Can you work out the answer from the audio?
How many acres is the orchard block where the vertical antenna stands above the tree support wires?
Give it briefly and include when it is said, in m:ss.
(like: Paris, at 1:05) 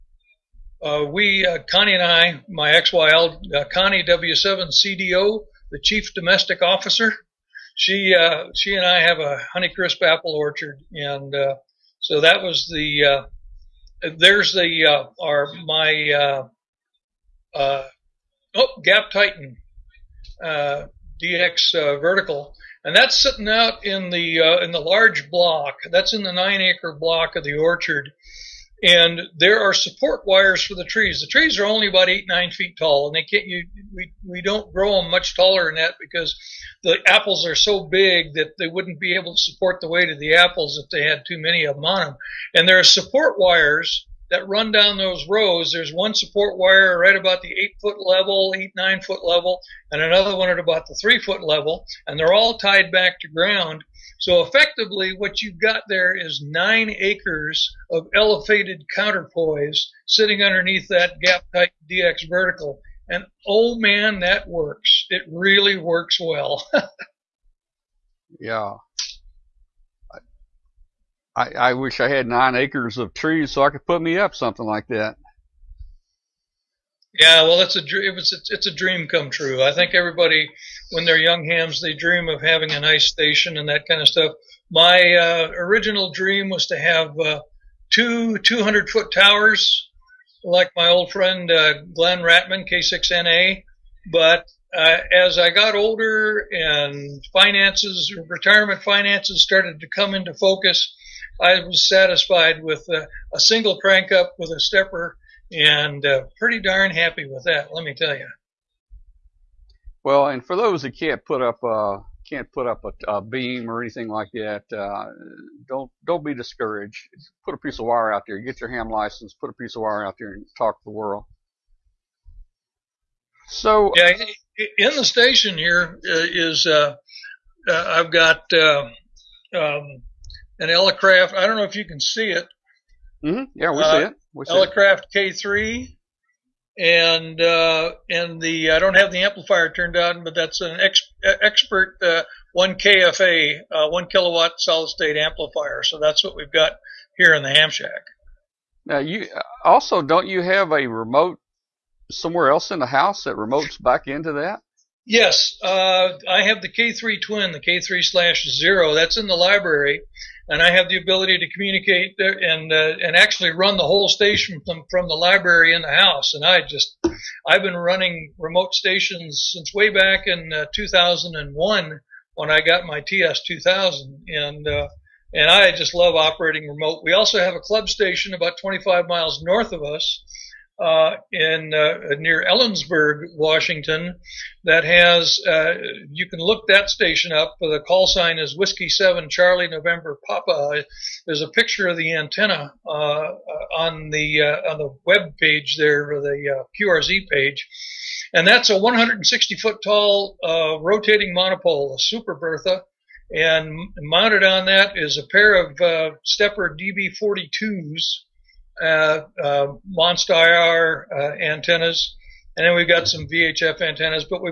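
9, at 0:26.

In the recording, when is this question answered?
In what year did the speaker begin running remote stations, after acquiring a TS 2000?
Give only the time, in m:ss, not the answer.
2:50.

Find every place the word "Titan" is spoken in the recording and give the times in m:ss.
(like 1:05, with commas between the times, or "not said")
0:19, 1:01.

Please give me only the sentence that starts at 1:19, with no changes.
I think everybody, when they're young hams, they dream of having a nice station and that kind of stuff.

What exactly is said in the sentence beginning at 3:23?
And mounted on that is a pair of SteppIR DB42s, uh, uh, uh, antennas, and then we've got some VHF antennas.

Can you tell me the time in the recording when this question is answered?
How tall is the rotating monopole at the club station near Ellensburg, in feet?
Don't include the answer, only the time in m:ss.
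3:18.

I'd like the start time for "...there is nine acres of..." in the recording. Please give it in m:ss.
0:55.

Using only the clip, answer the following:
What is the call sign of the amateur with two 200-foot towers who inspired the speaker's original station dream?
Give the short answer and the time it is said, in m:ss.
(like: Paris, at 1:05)
K6NA, at 1:32.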